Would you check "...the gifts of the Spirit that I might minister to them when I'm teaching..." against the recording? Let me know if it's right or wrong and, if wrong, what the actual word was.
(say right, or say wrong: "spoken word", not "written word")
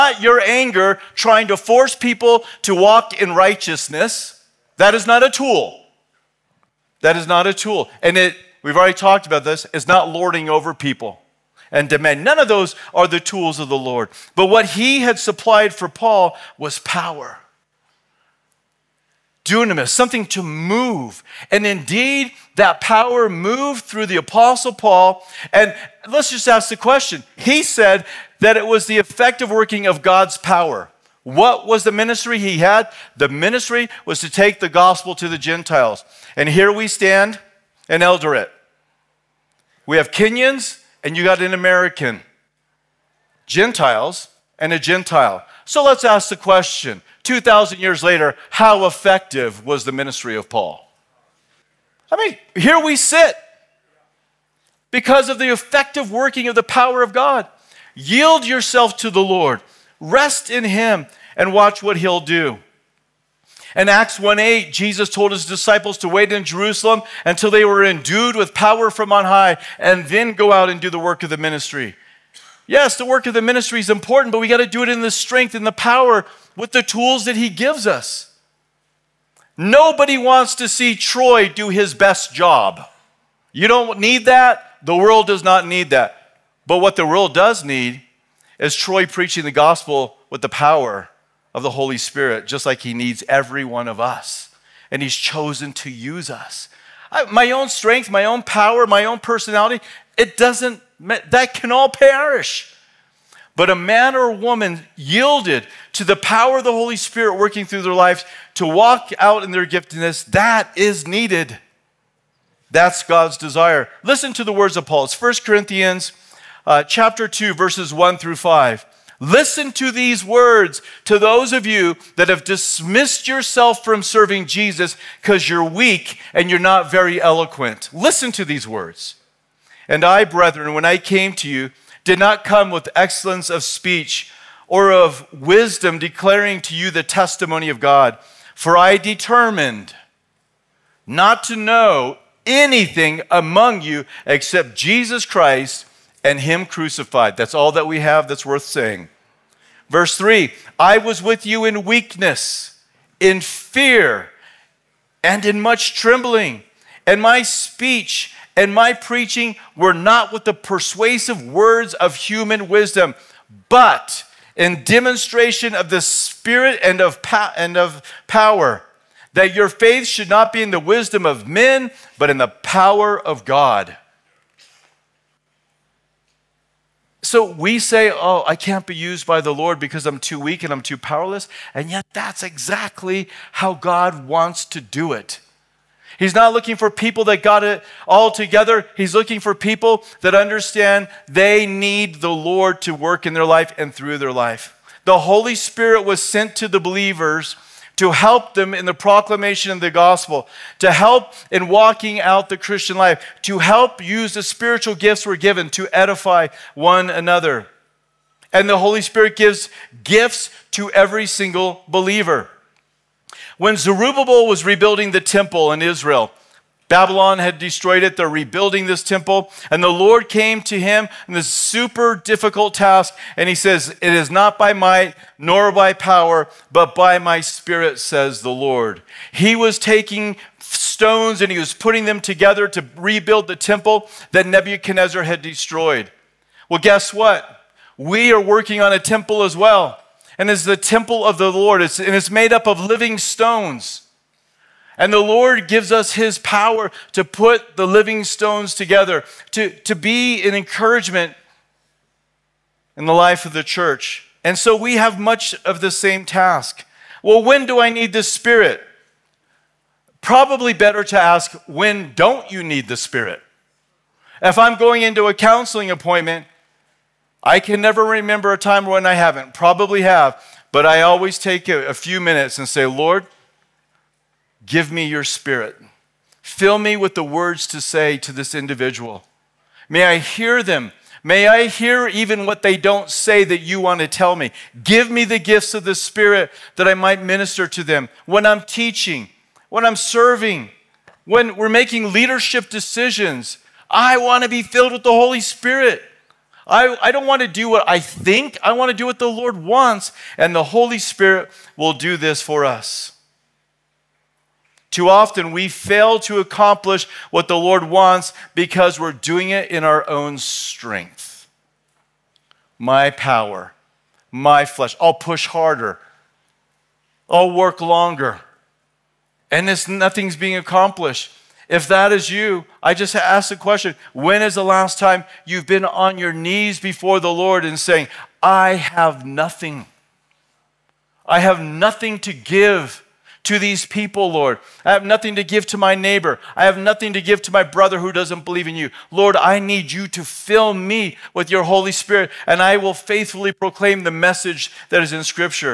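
right.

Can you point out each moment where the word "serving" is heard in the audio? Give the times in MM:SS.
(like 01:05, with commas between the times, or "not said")
02:04, 04:49.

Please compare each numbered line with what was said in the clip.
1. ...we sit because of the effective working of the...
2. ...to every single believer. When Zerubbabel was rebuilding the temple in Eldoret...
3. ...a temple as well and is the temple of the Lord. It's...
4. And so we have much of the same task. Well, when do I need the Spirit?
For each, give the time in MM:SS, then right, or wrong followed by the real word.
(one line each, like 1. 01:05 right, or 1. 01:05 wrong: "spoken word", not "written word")
1. 00:52 right
2. 03:30 wrong: "Israel", not "Eldoret"
3. 03:58 right
4. 04:14 right.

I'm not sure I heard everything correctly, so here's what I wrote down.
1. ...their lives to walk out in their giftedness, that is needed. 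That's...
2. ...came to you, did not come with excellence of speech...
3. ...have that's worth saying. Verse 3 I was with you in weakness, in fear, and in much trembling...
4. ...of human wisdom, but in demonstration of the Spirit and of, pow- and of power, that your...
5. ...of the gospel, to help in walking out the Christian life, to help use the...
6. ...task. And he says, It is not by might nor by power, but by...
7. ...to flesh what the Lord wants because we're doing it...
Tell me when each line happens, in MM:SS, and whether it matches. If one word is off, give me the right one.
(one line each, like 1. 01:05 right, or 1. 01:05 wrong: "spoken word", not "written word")
1. 01:47 right
2. 02:10 right
3. 02:27 right
4. 02:41 right
5. 03:19 right
6. 03:42 right
7. 05:06 wrong: "accomplish", not "flesh".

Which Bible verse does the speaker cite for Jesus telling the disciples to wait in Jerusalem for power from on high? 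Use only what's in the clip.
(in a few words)
Acts 1:8.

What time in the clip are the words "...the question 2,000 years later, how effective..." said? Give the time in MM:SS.
00:46.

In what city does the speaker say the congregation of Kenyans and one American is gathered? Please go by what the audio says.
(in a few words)
Eldoret.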